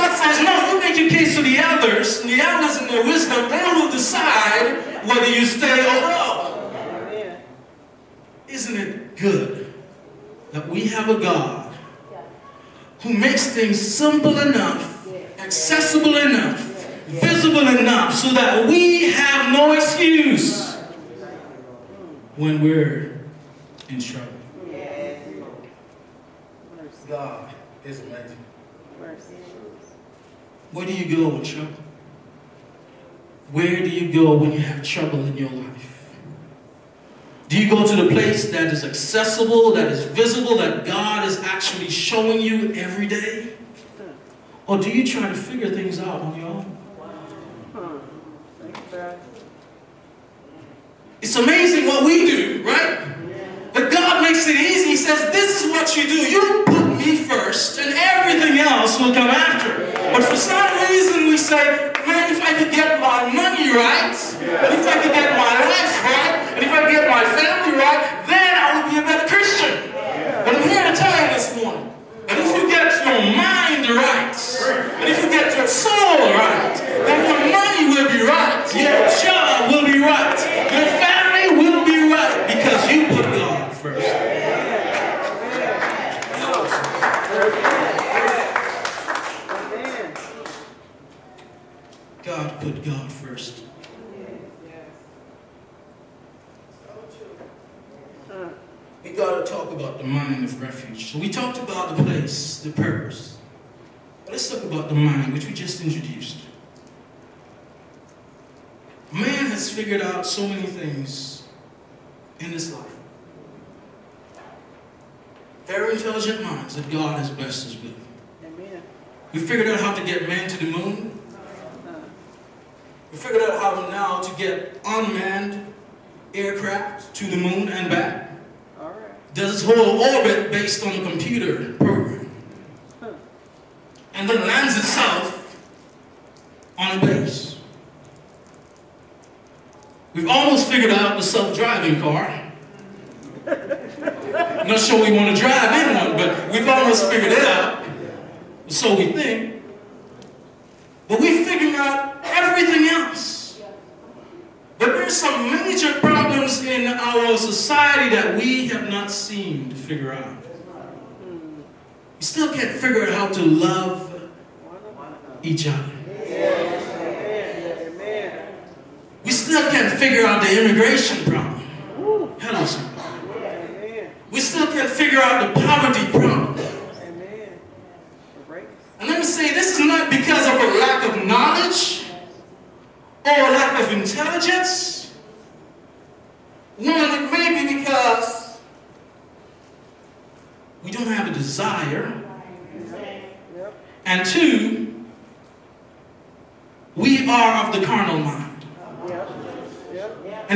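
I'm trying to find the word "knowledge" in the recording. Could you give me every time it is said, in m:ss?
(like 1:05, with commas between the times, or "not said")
3:01.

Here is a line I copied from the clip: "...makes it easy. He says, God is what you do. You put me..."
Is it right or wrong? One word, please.
wrong.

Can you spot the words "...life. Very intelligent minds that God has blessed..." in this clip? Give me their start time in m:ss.
1:52.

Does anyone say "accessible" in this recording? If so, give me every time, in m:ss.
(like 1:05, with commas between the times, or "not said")
0:15, 0:38.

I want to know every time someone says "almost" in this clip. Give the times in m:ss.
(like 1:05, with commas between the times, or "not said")
2:20, 2:26.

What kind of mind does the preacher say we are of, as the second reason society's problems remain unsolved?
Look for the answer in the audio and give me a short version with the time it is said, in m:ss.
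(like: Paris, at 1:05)
carnal, at 3:17.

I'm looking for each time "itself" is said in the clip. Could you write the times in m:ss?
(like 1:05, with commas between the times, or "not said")
2:14.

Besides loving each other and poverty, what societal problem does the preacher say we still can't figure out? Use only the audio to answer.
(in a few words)
immigration.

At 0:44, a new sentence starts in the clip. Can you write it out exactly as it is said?
Or do you try to figure things out on your own?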